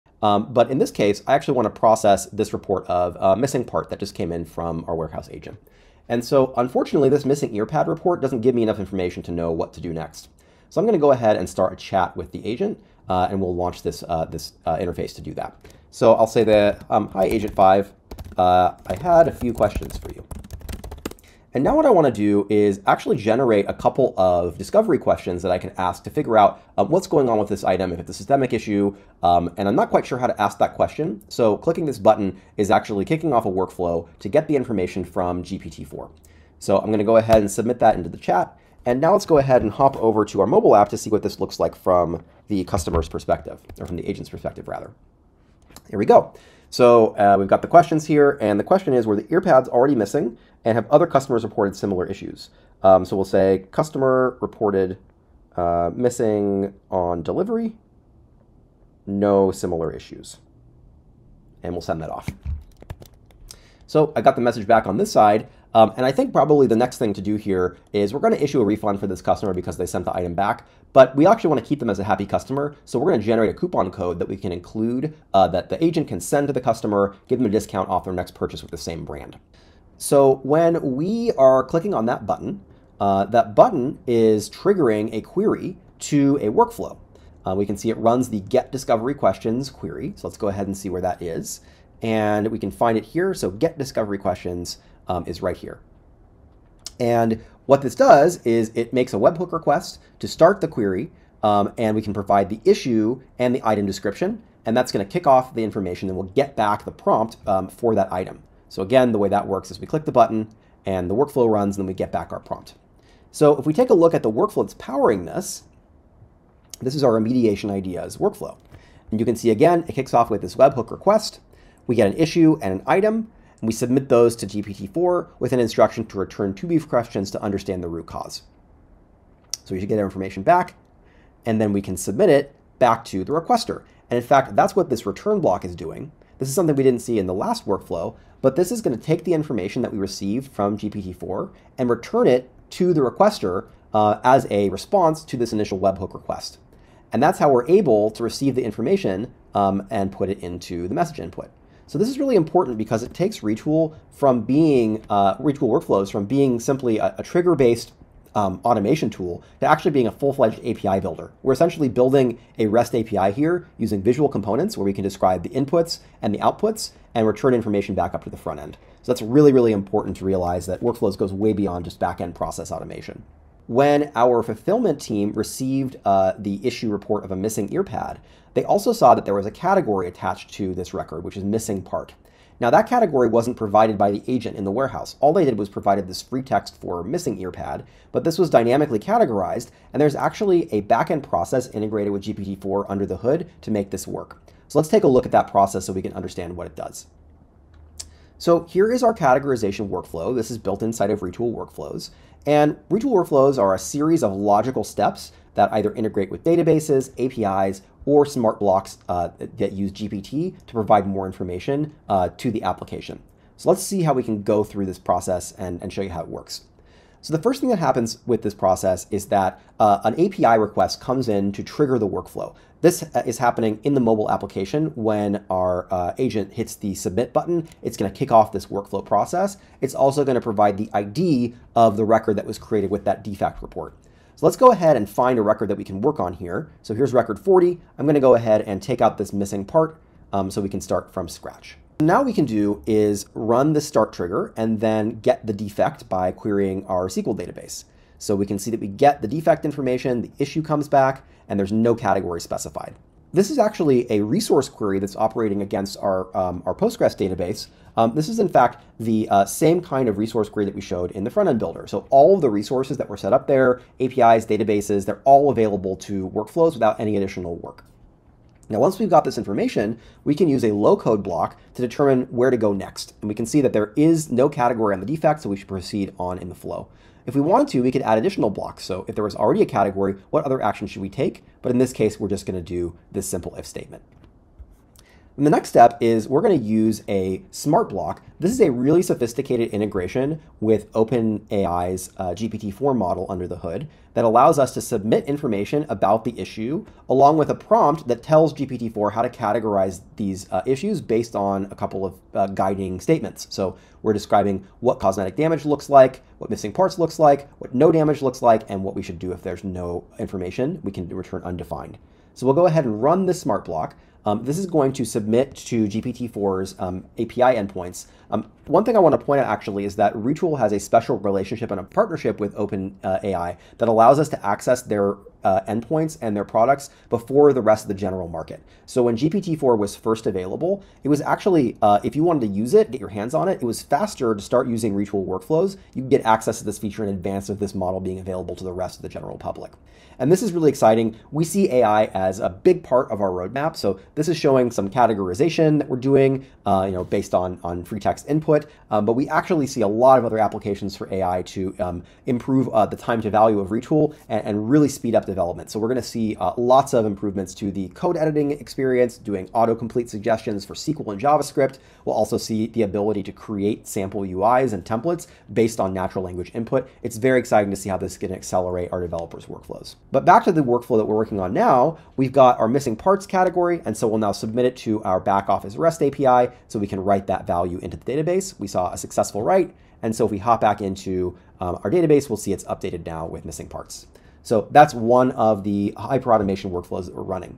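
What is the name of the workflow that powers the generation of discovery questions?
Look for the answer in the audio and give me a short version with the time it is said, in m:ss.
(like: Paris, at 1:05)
remediation ideas workflow, at 1:57.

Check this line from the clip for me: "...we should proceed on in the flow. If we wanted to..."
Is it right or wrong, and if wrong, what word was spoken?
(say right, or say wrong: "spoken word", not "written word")
right.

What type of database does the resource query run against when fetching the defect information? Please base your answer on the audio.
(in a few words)
Postgres.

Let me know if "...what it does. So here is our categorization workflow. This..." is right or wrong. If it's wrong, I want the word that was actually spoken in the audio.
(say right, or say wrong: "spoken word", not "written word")
right.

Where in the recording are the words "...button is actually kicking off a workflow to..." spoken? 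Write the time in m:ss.
0:31.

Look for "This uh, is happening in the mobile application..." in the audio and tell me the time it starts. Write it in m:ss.
3:42.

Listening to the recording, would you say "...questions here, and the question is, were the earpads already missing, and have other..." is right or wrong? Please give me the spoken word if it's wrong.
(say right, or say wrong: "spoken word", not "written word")
right.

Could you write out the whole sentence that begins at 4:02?
Now we can do is run the start trigger and then get the defect by querying our SQL database.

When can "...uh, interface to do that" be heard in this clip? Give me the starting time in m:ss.
0:14.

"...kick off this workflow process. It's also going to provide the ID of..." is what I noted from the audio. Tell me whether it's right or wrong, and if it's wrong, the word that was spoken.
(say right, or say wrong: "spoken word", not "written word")
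right.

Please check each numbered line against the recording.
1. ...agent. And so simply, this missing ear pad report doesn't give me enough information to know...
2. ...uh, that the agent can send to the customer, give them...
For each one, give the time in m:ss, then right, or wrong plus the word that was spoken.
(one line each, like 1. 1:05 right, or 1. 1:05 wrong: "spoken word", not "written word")
1. 0:05 wrong: "unfortunately", not "simply"
2. 1:15 right.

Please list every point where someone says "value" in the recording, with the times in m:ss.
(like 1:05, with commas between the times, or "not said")
5:53, 6:17.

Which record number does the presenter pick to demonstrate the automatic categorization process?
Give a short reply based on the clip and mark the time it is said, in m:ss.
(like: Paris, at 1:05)
40, at 3:57.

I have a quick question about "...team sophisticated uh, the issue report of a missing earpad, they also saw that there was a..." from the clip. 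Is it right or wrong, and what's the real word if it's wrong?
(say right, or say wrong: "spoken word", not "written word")
wrong: "received", not "sophisticated".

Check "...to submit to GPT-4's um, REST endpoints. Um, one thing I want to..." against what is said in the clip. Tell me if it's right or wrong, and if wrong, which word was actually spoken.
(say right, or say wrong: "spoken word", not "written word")
wrong: "API", not "REST".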